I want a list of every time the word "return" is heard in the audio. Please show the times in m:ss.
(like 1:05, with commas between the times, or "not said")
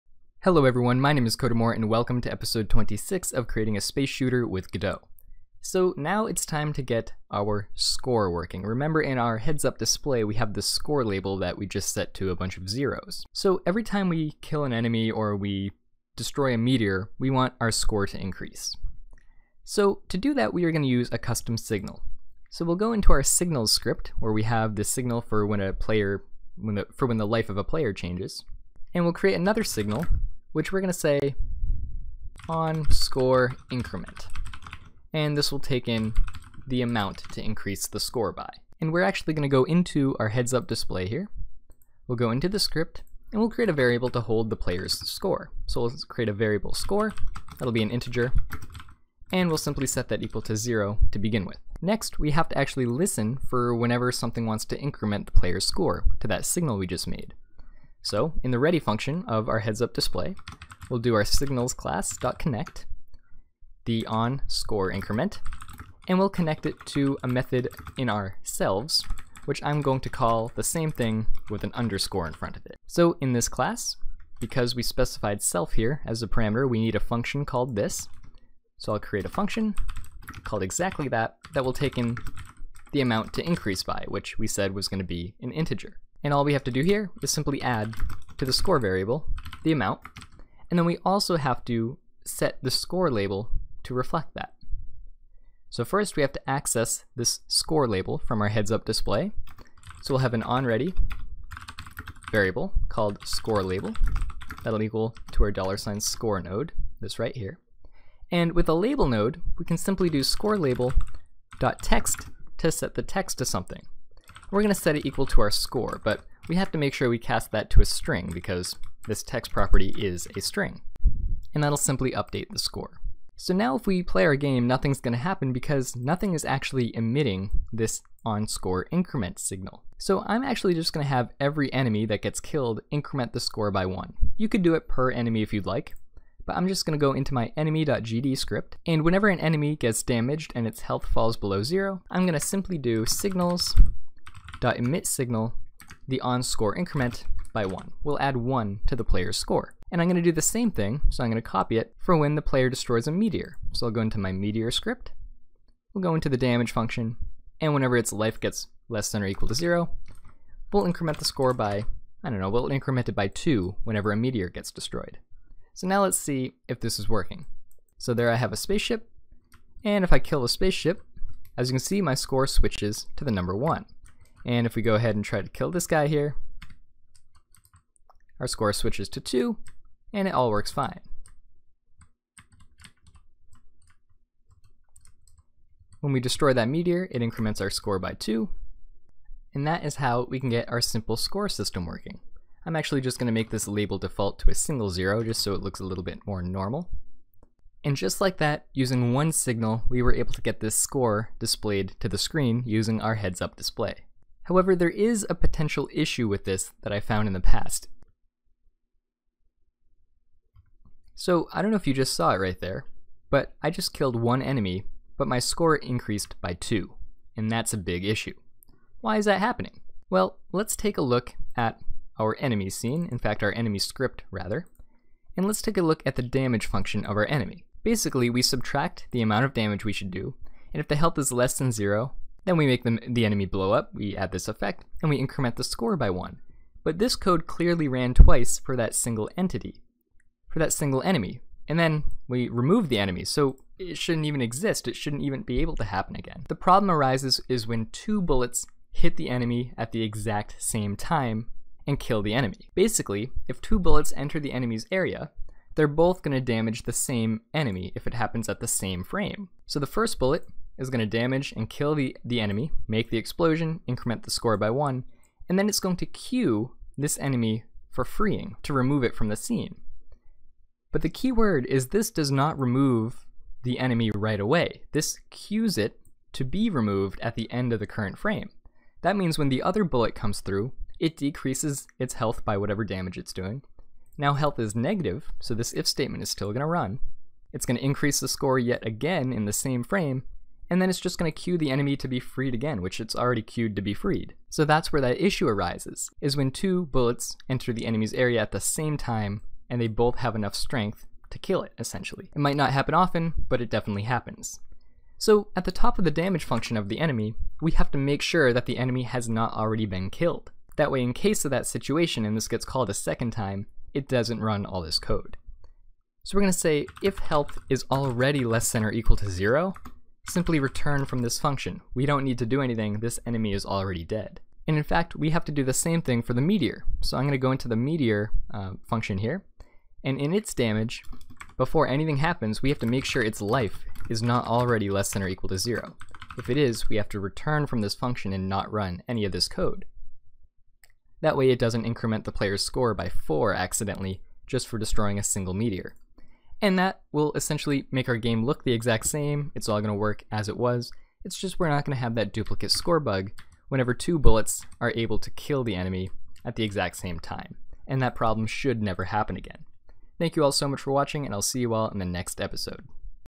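5:20, 5:37.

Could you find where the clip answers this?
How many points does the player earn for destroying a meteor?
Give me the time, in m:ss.
2:42.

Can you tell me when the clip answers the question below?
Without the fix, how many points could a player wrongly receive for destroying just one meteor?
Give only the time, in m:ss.
5:42.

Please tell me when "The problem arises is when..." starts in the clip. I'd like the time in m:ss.
4:06.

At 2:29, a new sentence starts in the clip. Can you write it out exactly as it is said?
And I'm going to do the same thing, so I'm going to copy it for when the player destroys a meteor.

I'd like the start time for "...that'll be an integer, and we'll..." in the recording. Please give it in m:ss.
0:47.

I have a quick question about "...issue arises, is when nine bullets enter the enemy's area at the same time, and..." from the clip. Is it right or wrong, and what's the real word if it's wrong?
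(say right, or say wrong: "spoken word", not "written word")
wrong: "two", not "nine".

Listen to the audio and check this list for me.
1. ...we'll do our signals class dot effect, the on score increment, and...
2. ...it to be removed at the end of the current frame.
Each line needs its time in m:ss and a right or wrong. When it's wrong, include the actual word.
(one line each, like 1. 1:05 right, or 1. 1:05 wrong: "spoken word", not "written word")
1. 1:00 wrong: "connect", not "effect"
2. 4:35 right.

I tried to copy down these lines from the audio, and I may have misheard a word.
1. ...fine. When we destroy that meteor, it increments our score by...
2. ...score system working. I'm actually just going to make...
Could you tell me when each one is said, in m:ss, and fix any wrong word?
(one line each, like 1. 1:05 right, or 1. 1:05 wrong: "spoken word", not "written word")
1. 3:00 right
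2. 3:11 right.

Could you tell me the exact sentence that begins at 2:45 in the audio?
So now let's see if this is working.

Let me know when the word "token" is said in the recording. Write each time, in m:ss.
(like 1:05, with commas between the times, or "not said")
not said.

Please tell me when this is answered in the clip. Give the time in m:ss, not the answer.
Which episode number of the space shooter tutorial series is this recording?
0:02.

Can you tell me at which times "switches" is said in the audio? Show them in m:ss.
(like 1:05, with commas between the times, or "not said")
2:52, 2:58.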